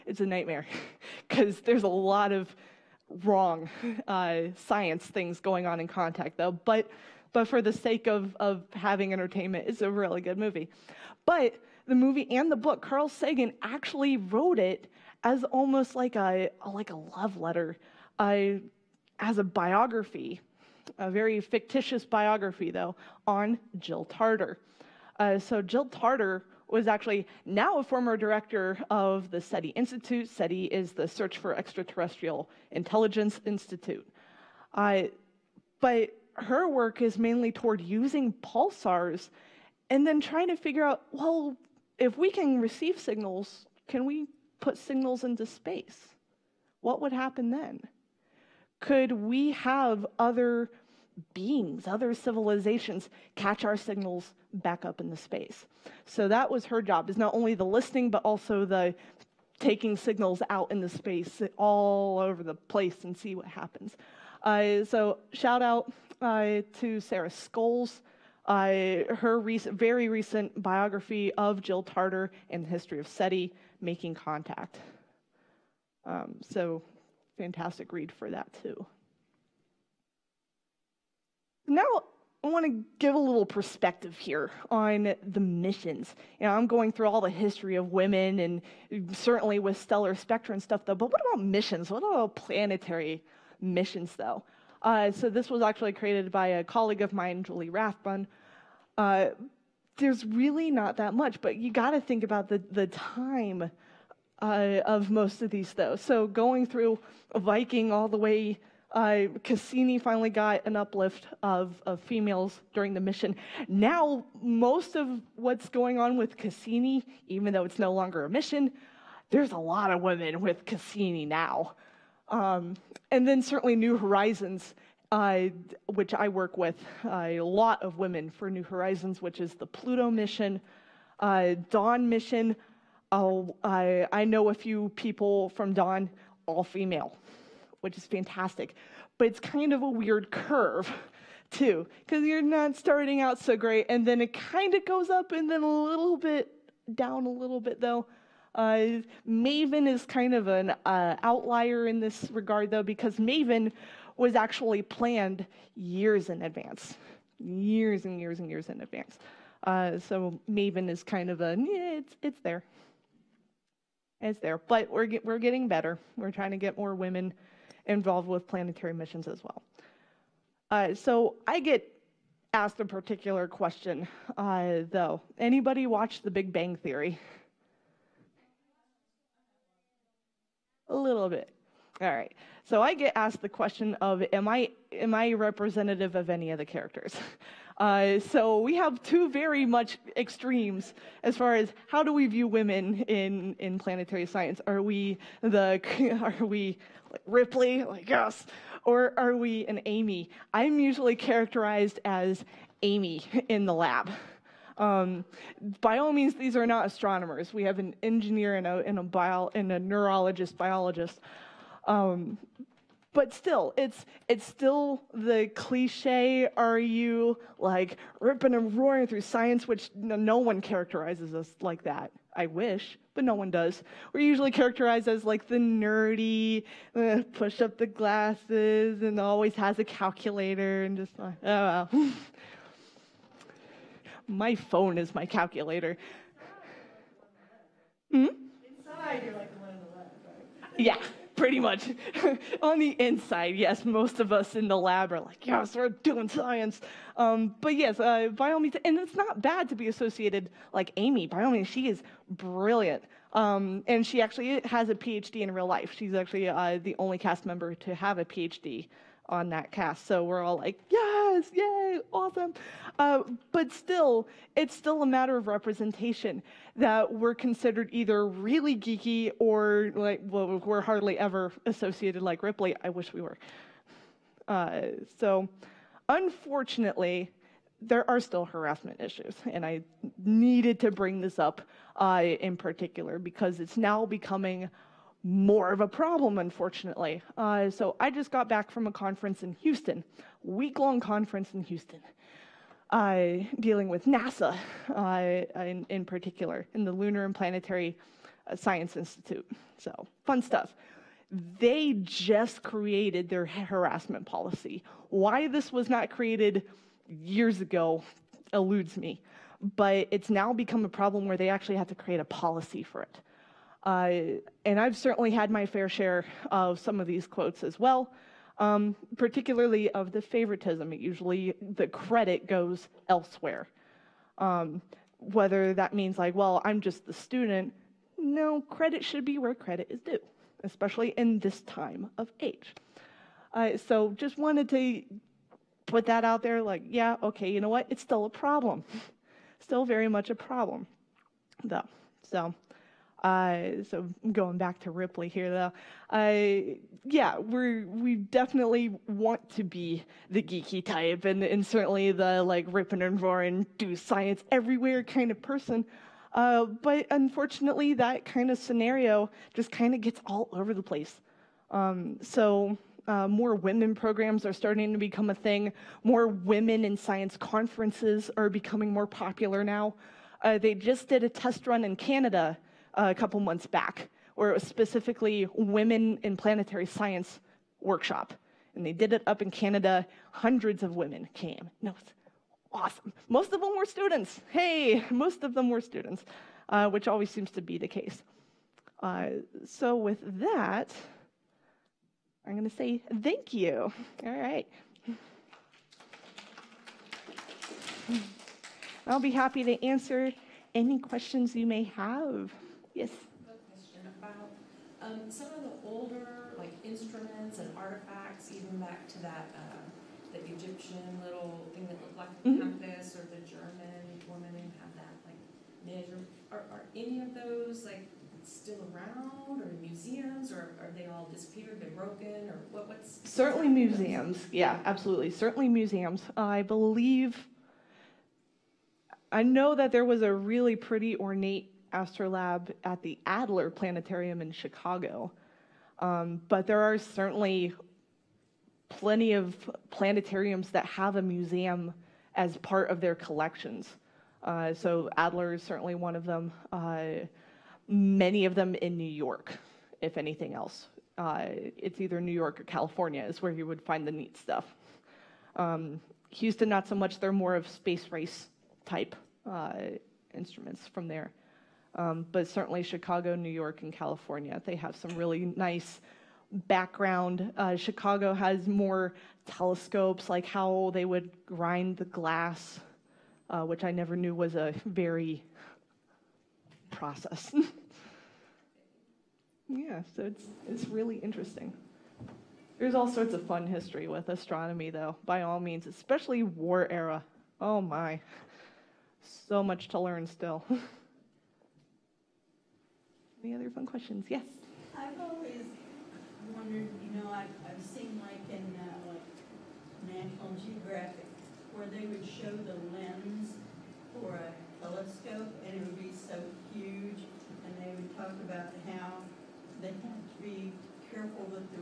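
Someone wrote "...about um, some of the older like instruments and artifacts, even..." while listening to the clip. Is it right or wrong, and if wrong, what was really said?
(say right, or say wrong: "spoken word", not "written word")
right.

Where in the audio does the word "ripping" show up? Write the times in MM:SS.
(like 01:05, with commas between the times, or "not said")
03:38, 05:52.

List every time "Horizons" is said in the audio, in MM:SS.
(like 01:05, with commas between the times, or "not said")
02:03, 02:08.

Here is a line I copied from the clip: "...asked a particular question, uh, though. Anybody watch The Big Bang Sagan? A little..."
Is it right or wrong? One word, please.
wrong.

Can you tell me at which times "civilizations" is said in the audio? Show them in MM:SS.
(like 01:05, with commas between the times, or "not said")
00:52.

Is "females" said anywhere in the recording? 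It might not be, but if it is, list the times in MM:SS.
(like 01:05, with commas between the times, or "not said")
01:51, 02:16.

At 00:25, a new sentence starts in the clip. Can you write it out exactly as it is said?
Uh, so Jill Tarter was actually now a former director of the SETI Institute.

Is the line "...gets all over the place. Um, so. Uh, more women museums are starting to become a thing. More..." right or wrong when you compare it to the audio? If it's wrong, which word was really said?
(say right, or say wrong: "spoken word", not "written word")
wrong: "programs", not "museums".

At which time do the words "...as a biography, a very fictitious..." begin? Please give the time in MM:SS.
00:19.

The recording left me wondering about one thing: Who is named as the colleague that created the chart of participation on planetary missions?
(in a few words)
Julie Rathbun.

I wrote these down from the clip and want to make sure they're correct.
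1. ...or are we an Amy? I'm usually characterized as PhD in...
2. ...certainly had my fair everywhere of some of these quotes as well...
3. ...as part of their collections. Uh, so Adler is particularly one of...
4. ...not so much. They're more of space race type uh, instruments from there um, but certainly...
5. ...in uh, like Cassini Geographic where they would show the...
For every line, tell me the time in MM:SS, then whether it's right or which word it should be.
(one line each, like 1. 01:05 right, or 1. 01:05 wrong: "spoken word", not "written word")
1. 03:18 wrong: "Amy", not "PhD"
2. 05:14 wrong: "share", not "everywhere"
3. 07:22 wrong: "certainly", not "particularly"
4. 07:36 right
5. 08:18 wrong: "National", not "Cassini".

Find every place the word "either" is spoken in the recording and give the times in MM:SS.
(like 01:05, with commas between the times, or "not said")
04:27, 07:32.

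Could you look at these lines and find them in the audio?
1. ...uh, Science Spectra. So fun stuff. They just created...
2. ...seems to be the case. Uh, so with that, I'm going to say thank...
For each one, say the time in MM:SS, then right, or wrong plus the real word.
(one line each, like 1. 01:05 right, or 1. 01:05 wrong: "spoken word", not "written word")
1. 04:58 wrong: "Institute", not "Spectra"
2. 06:27 right.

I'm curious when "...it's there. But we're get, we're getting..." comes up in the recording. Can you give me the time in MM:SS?
02:44.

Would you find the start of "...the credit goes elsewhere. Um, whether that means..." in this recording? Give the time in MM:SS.
05:21.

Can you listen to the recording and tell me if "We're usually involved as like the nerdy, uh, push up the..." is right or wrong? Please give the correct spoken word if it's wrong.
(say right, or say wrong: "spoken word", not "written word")
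wrong: "characterized", not "involved".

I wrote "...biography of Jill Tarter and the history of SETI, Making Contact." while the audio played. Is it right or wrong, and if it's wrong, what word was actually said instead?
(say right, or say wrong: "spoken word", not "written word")
right.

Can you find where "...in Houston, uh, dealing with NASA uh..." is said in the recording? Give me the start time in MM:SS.
04:51.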